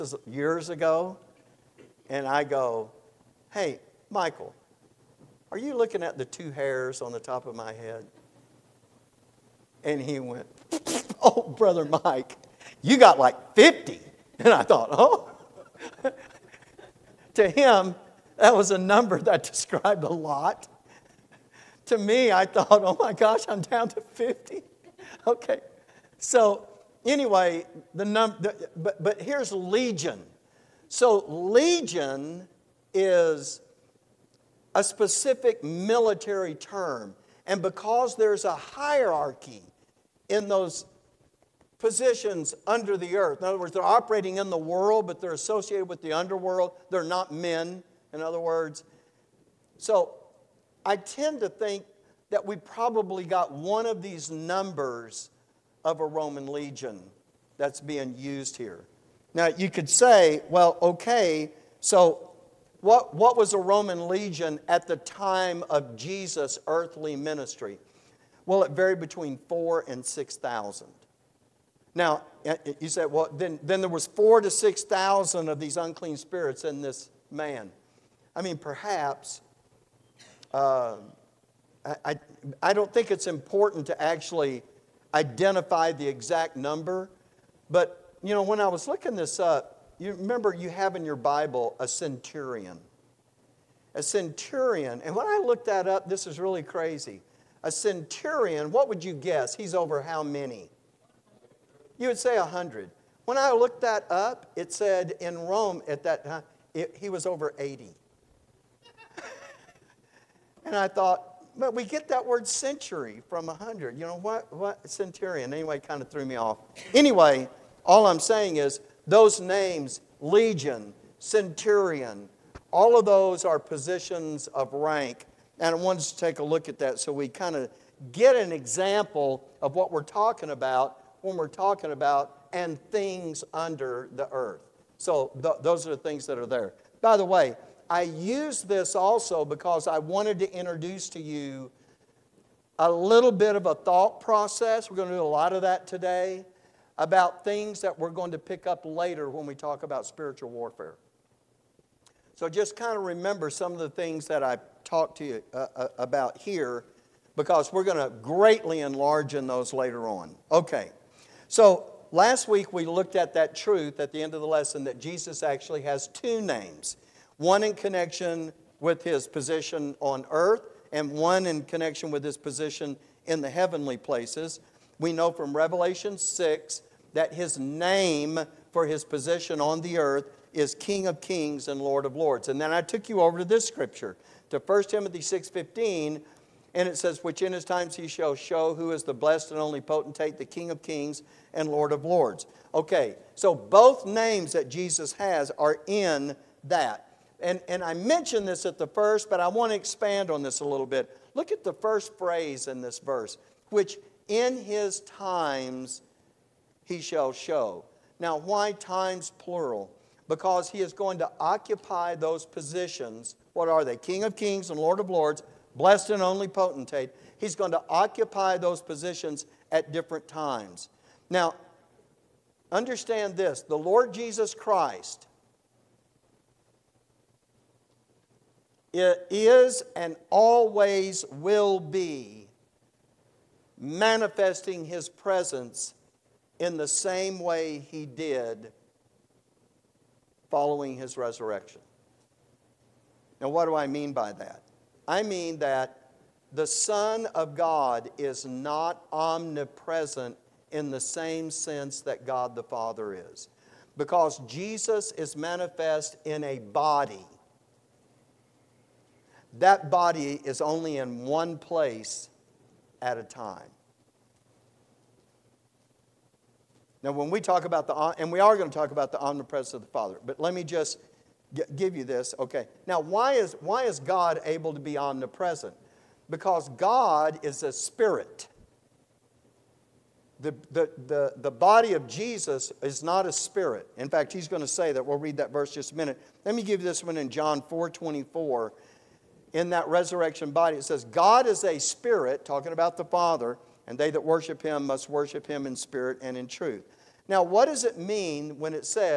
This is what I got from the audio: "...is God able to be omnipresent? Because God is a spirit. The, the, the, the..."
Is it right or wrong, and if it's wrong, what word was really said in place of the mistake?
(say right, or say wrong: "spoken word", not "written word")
right.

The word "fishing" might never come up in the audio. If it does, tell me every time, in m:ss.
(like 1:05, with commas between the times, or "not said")
not said.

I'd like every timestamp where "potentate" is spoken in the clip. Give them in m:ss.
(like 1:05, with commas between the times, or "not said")
3:09, 3:36.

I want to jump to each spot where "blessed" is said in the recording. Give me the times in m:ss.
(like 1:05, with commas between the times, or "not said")
3:09, 3:35.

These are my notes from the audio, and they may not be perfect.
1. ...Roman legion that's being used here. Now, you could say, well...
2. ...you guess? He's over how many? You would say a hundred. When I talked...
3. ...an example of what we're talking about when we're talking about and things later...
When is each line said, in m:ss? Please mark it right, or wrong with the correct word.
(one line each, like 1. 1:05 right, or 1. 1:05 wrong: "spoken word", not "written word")
1. 0:56 right
2. 1:39 wrong: "looked", not "talked"
3. 2:08 wrong: "under", not "later".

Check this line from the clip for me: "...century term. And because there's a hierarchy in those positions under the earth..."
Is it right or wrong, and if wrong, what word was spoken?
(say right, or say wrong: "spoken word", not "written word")
wrong: "military", not "century".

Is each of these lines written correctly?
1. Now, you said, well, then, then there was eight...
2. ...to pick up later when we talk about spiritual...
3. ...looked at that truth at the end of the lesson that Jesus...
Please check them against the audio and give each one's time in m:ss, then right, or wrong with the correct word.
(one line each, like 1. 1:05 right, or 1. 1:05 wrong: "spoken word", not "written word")
1. 1:11 wrong: "four", not "eight"
2. 2:28 right
3. 2:42 right.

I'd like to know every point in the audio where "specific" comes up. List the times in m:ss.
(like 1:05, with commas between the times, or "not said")
0:34.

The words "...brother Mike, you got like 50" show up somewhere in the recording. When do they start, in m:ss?
0:11.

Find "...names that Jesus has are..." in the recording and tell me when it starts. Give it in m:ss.
3:14.